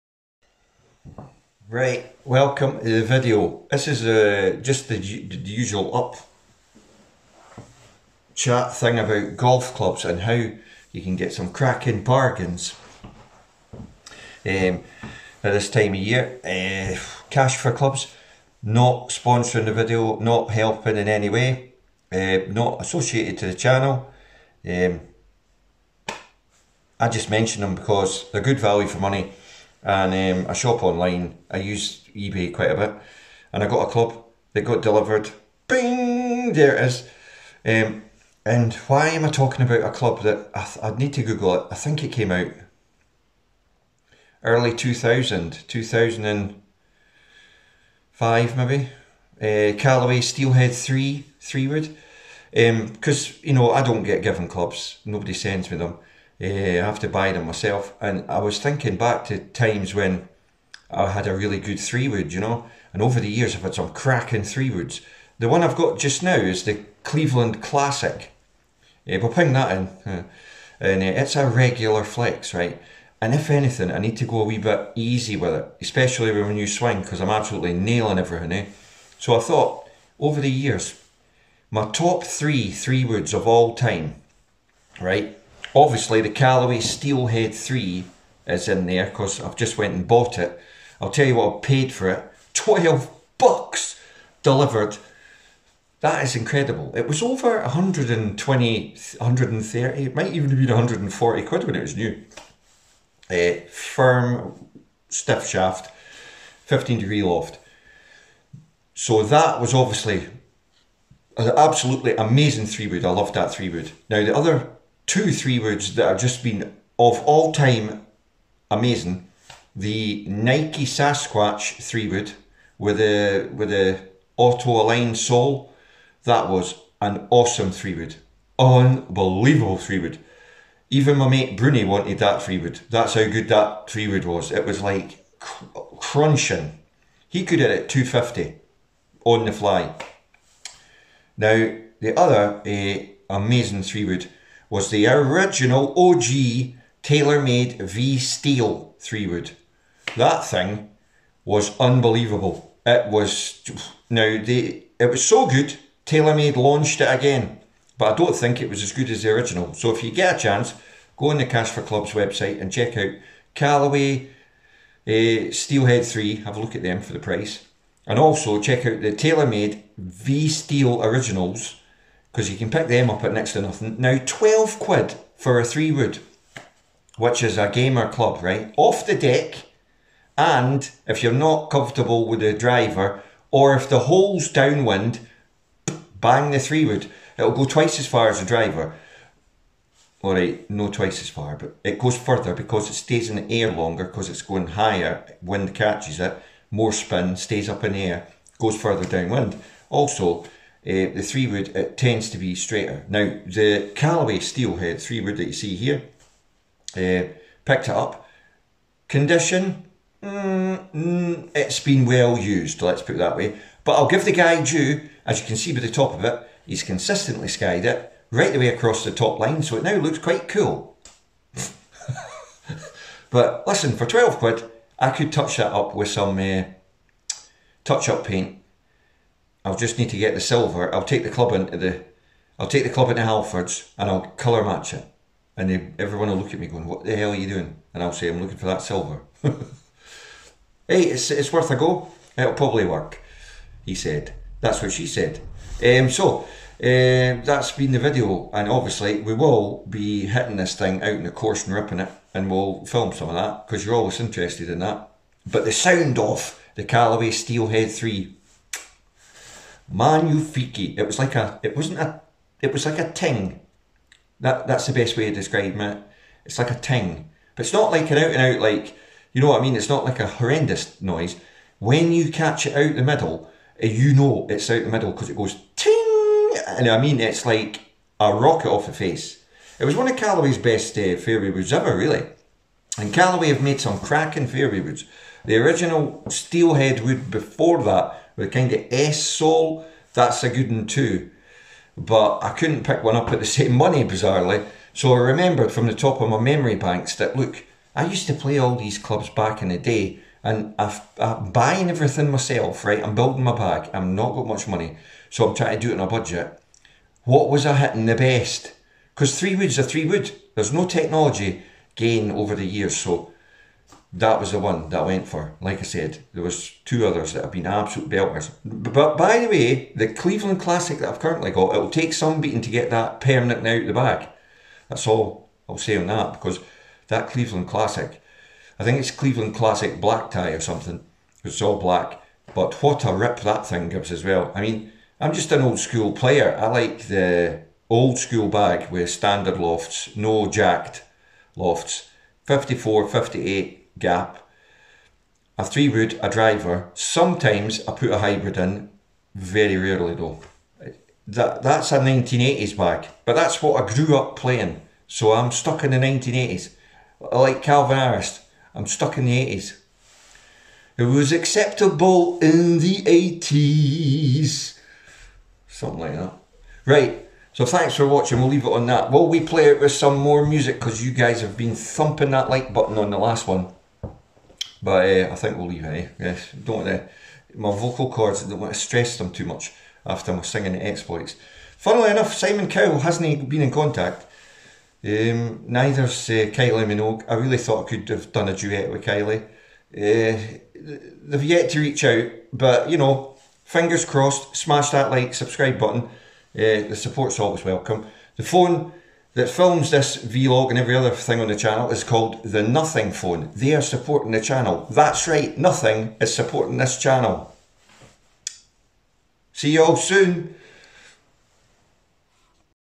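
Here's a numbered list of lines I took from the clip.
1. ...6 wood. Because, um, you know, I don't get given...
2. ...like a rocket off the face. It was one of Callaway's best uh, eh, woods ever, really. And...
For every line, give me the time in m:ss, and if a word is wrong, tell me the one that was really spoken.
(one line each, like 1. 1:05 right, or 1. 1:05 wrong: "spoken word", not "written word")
1. 0:51 wrong: "3", not "6"
2. 4:37 right.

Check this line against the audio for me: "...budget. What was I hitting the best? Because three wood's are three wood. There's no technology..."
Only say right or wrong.
right.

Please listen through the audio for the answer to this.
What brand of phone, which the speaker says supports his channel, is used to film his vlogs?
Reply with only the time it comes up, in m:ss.
6:42.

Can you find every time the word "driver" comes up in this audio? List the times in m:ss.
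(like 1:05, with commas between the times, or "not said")
3:02, 3:08, 5:46.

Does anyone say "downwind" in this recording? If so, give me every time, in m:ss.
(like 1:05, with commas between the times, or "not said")
3:04, 3:19.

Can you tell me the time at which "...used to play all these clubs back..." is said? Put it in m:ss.
4:58.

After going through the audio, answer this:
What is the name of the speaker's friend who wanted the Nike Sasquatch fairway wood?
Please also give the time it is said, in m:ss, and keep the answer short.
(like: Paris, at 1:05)
Bruni, at 2:11.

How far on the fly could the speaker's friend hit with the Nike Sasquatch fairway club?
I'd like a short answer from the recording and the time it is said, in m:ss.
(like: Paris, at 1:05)
250, at 2:17.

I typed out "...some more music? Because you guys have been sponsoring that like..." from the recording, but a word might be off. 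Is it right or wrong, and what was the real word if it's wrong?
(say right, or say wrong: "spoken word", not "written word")
wrong: "thumping", not "sponsoring".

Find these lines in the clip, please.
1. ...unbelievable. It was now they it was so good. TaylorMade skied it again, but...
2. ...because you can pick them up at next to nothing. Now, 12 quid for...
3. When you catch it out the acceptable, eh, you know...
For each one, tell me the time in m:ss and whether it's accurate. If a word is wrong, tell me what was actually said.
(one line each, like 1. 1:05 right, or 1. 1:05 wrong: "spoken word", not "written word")
1. 2:31 wrong: "launched", not "skied"
2. 2:52 right
3. 4:31 wrong: "middle", not "acceptable".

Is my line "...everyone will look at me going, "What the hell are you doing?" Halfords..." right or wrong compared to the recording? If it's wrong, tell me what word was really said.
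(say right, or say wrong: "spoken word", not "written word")
wrong: "And", not "Halfords".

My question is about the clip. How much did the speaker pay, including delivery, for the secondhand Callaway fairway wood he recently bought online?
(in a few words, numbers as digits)
12 bucks.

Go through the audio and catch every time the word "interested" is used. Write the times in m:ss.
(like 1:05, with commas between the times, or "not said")
4:14.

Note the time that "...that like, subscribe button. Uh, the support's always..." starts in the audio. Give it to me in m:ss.
6:34.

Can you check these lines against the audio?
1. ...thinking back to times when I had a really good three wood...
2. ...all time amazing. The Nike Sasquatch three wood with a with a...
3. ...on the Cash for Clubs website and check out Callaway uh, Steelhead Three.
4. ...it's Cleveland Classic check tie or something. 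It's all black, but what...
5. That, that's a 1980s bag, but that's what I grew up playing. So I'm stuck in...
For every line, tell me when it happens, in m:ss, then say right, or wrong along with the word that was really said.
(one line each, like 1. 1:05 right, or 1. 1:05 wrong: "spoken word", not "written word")
1. 0:58 right
2. 1:57 right
3. 2:41 right
4. 5:28 wrong: "black", not "check"
5. 5:51 right.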